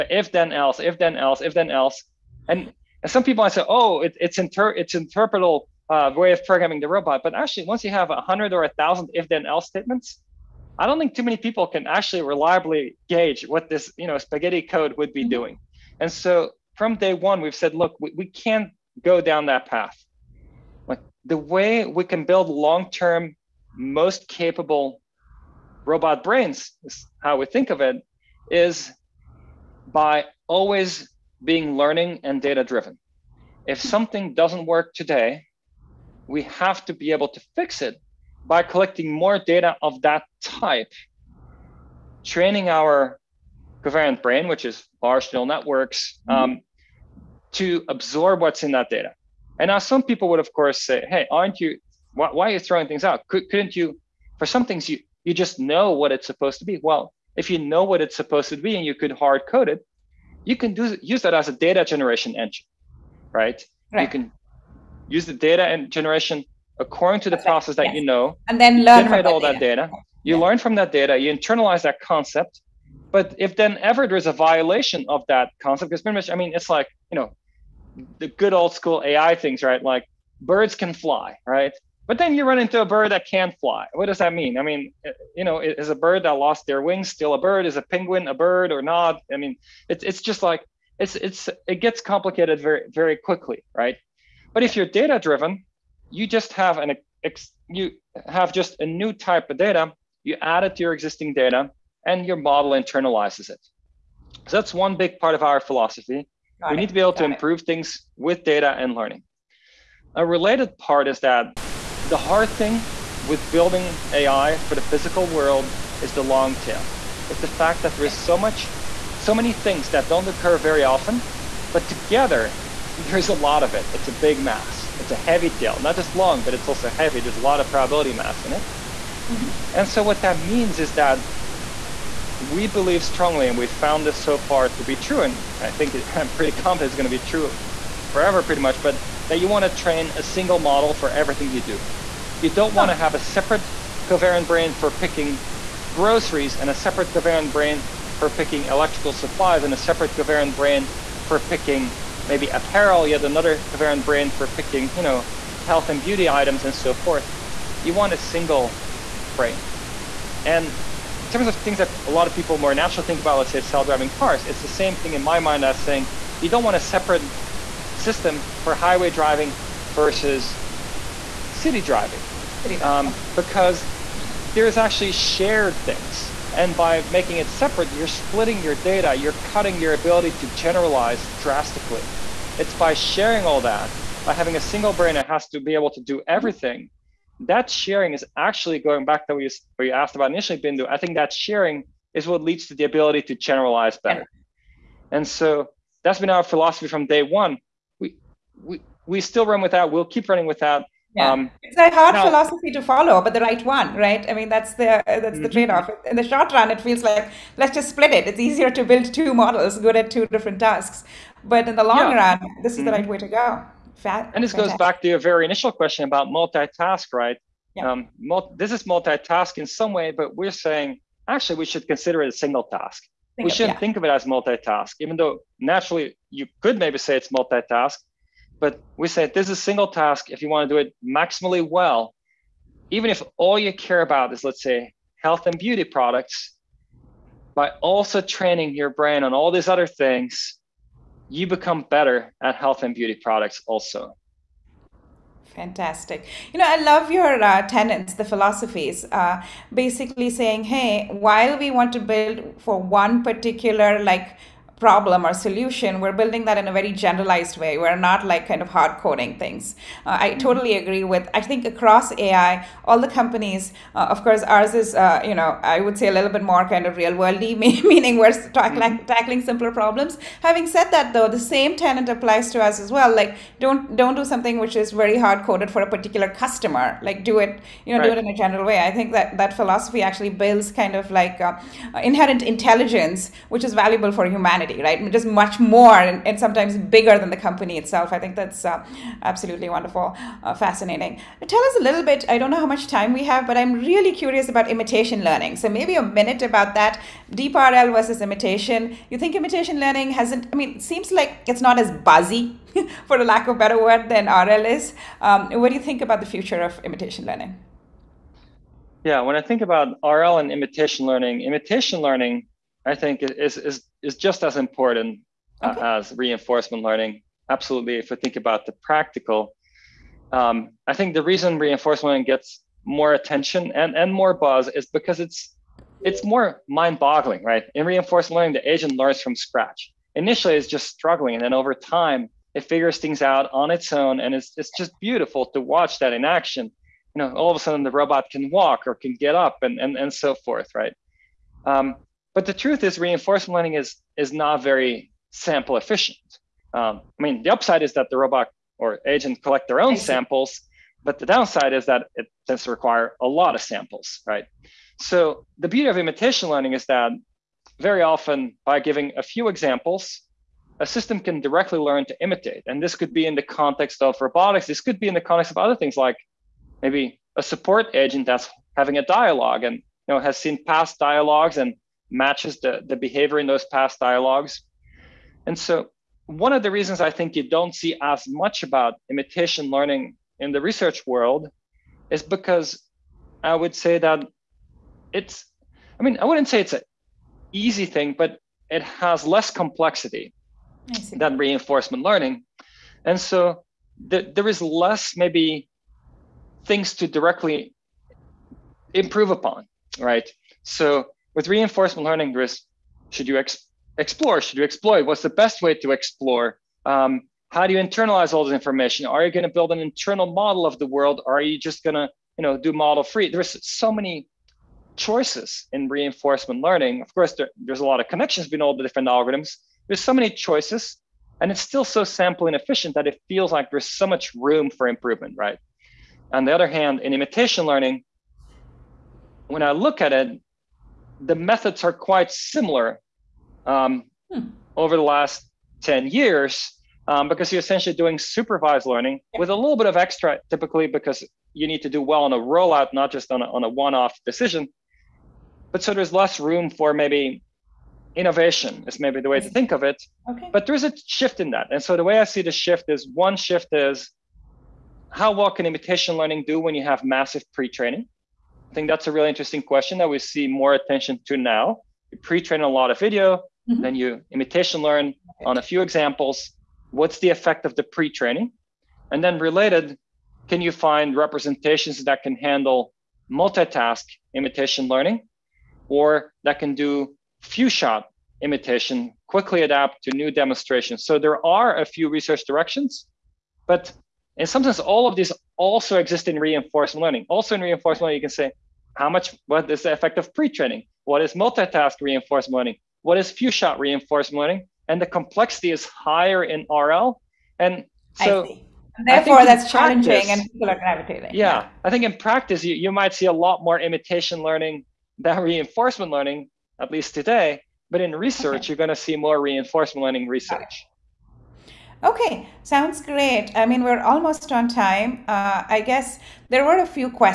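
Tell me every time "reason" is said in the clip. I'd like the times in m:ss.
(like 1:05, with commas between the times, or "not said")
5:21, 6:16.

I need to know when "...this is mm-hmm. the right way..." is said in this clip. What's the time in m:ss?
3:32.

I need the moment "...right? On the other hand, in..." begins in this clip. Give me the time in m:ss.
7:05.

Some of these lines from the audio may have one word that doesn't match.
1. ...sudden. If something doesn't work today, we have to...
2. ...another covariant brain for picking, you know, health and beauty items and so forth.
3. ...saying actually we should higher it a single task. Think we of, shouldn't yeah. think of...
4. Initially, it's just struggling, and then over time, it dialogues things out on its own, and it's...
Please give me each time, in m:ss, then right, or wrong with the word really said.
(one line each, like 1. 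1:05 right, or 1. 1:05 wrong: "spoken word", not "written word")
1. 0:32 wrong: "driven", not "sudden"
2. 2:33 right
3. 3:40 wrong: "consider", not "higher"
4. 5:30 wrong: "figures", not "dialogues".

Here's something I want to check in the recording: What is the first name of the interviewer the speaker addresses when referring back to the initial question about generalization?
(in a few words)
Bindu.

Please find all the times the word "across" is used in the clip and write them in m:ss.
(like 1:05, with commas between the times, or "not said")
4:21.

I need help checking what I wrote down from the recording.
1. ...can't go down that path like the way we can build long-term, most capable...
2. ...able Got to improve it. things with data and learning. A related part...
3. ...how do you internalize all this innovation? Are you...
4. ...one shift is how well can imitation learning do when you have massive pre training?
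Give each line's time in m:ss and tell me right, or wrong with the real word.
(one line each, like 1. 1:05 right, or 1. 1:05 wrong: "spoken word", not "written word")
1. 0:18 right
2. 1:46 right
3. 6:47 wrong: "information", not "innovation"
4. 7:33 right.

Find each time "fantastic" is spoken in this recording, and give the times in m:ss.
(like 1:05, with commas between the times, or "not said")
3:34, 4:05.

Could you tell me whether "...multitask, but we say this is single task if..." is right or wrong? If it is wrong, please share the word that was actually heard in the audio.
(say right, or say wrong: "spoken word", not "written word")
right.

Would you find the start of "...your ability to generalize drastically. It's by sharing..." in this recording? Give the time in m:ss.
2:59.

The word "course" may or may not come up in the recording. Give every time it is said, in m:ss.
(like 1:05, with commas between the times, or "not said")
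0:50, 4:24, 6:57.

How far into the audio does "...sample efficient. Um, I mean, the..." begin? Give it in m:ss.
5:45.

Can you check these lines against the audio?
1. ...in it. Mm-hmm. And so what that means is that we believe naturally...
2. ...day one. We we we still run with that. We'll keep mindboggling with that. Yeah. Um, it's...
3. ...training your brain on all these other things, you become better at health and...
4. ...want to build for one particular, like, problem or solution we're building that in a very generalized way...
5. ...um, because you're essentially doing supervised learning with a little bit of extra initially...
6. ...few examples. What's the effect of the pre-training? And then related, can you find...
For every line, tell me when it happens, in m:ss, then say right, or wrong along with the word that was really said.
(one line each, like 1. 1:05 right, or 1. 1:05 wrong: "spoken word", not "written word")
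1. 2:08 wrong: "strongly", not "naturally"
2. 3:17 wrong: "running", not "mindboggling"
3. 3:58 right
4. 4:11 right
5. 7:17 wrong: "typically", not "initially"
6. 7:45 right.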